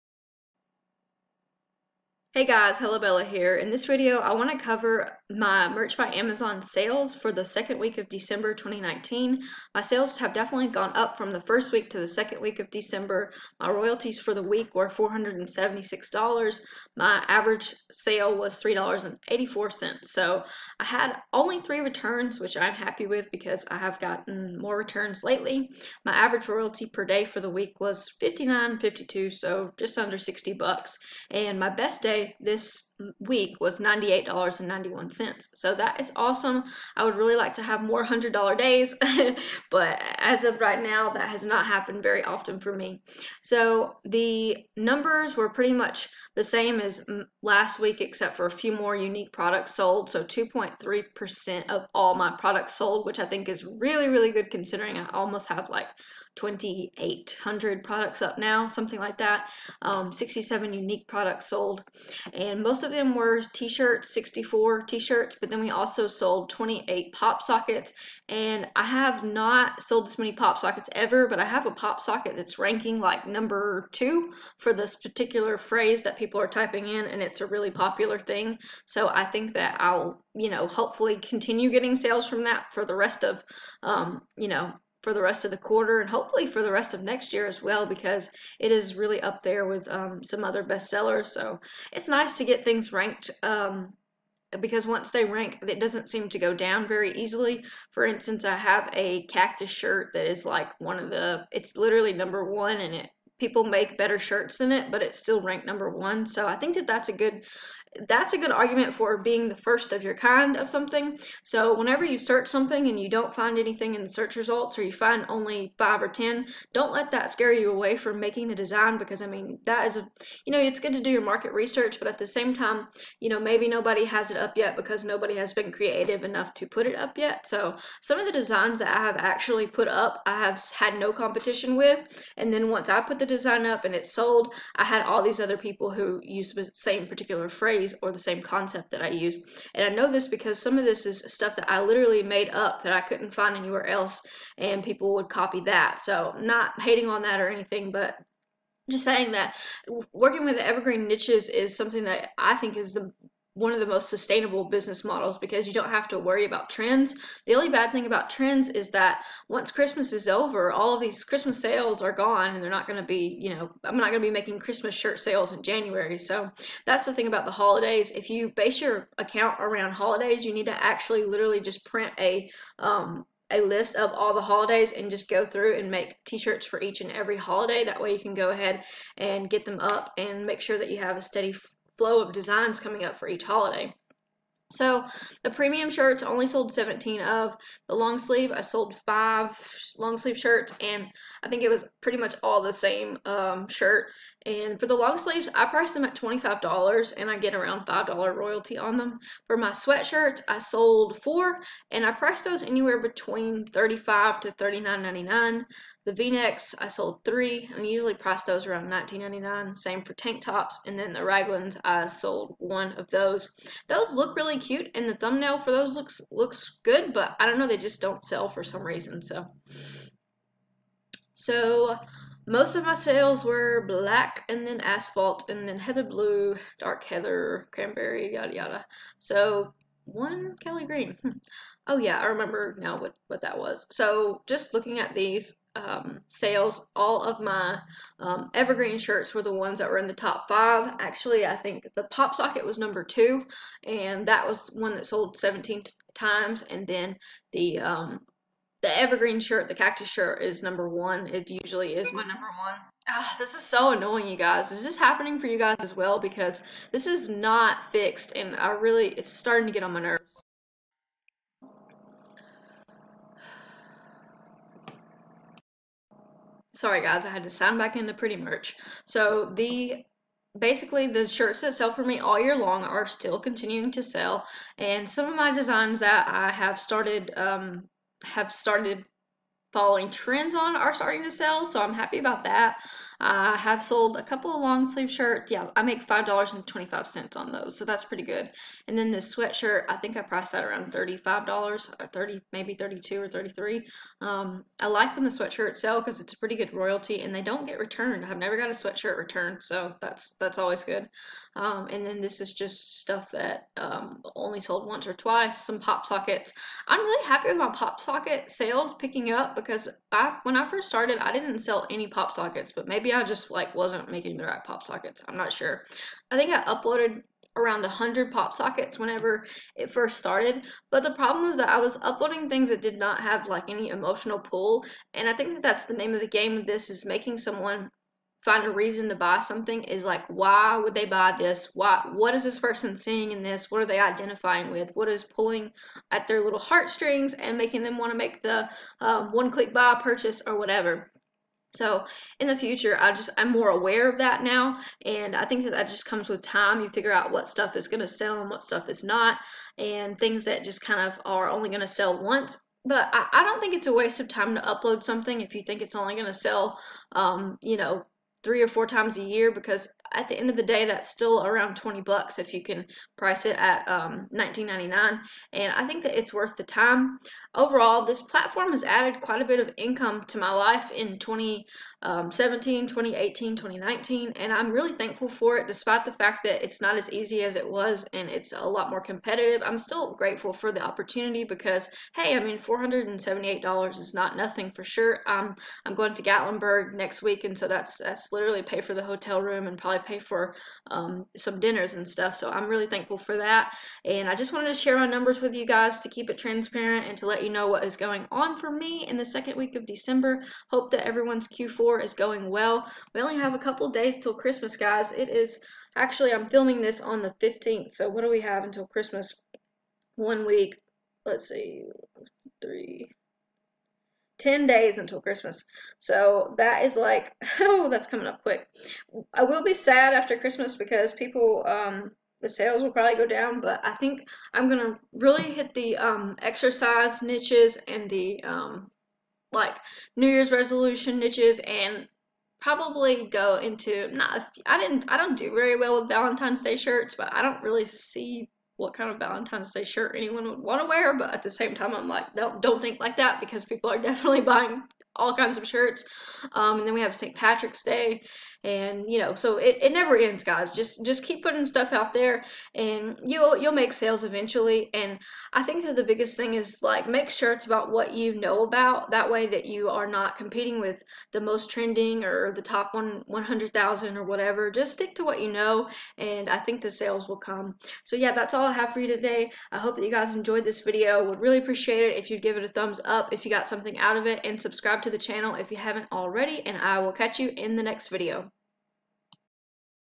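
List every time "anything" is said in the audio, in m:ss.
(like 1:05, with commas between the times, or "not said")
1:53, 2:27.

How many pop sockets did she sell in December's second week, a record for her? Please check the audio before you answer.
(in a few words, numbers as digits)
28.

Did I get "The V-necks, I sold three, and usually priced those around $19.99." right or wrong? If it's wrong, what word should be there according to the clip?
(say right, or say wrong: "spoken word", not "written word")
right.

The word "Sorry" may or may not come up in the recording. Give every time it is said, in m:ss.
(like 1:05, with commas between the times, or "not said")
4:26.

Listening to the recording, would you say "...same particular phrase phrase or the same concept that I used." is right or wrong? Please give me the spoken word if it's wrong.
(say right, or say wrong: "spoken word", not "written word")
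right.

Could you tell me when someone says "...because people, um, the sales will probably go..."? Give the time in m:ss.
7:00.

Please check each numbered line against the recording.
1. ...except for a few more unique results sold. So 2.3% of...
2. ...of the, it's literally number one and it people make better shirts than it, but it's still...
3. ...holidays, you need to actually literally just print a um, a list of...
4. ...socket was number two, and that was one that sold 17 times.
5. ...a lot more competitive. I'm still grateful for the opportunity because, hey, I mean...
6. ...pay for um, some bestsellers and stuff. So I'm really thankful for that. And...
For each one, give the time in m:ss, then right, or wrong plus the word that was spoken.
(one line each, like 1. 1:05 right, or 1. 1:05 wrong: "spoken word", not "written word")
1. 0:48 wrong: "products", not "results"
2. 1:40 right
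3. 2:49 right
4. 4:02 right
5. 6:18 right
6. 6:30 wrong: "dinners", not "bestsellers".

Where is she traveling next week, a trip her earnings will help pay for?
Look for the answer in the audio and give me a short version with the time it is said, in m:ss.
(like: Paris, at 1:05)
Gatlinburg, at 6:26.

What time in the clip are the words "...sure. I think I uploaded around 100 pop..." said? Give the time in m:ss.
5:15.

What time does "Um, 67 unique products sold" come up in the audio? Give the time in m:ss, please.
0:59.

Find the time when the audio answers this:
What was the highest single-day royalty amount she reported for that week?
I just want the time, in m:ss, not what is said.
0:33.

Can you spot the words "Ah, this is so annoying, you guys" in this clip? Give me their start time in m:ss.
4:13.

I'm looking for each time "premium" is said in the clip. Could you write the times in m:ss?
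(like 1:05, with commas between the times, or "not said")
3:05.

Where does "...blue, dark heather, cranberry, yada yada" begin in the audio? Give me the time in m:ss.
3:46.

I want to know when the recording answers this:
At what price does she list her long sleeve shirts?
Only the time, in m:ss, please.
3:16.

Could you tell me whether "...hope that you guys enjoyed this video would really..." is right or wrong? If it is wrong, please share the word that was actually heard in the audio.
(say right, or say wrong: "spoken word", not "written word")
right.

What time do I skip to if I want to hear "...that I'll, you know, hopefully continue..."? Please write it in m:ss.
1:19.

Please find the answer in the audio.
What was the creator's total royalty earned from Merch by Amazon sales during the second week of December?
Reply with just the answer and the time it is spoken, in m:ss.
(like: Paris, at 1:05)
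$476, at 0:14.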